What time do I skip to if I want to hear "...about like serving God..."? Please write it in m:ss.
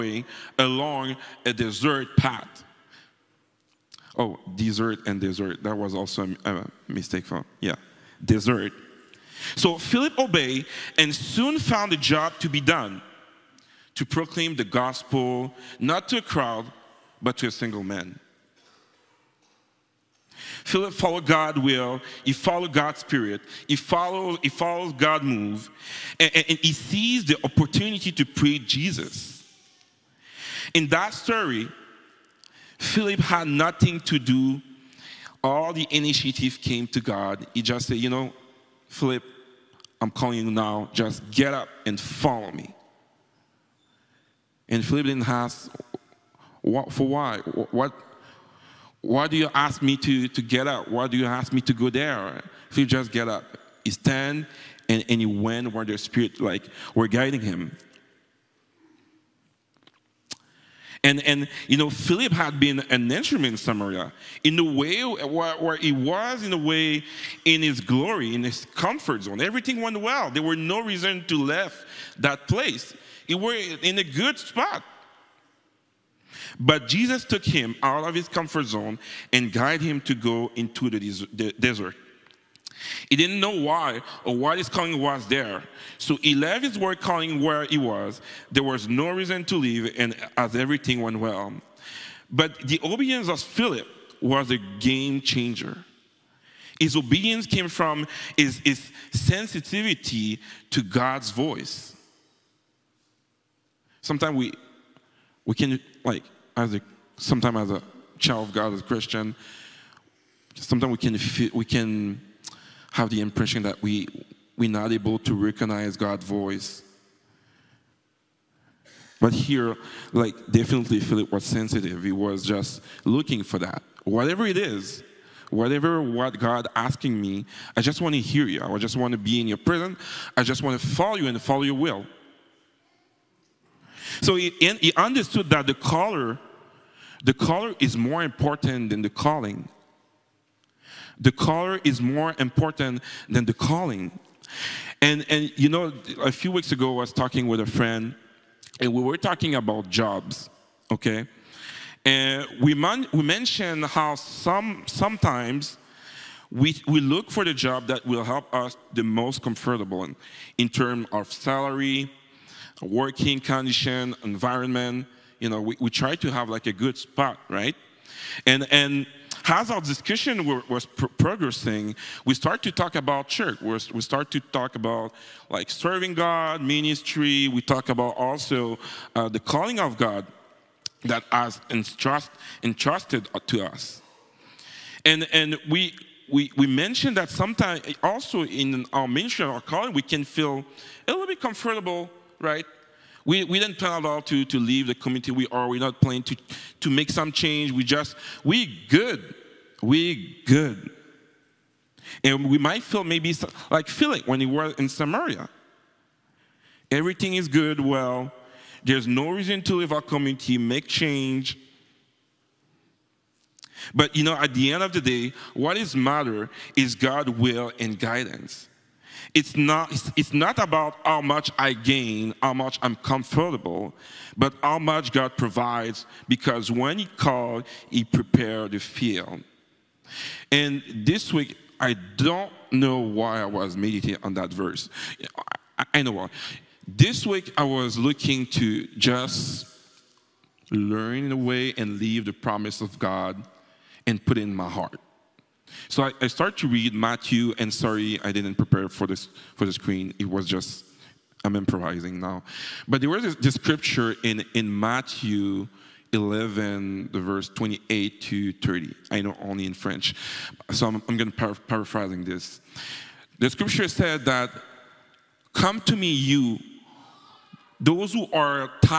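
2:54.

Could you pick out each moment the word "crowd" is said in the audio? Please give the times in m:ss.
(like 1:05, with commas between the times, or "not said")
0:16.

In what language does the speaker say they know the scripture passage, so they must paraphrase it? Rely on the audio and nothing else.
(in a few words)
French.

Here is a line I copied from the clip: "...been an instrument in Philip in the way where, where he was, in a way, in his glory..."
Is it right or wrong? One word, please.
wrong.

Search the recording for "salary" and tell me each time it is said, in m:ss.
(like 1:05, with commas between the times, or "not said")
2:41.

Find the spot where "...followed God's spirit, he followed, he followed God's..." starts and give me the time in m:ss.
0:22.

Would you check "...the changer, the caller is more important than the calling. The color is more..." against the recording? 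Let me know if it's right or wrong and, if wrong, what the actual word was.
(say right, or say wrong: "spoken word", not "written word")
wrong: "caller", not "changer".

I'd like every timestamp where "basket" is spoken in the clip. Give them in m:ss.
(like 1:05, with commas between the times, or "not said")
not said.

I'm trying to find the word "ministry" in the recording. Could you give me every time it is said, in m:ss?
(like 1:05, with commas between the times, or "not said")
2:56, 3:09.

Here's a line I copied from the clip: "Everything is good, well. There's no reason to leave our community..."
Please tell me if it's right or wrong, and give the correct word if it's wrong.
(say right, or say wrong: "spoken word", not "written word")
right.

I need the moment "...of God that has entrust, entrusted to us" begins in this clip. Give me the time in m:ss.
2:59.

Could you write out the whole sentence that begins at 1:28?
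There was no reason to leave, and as everything went well.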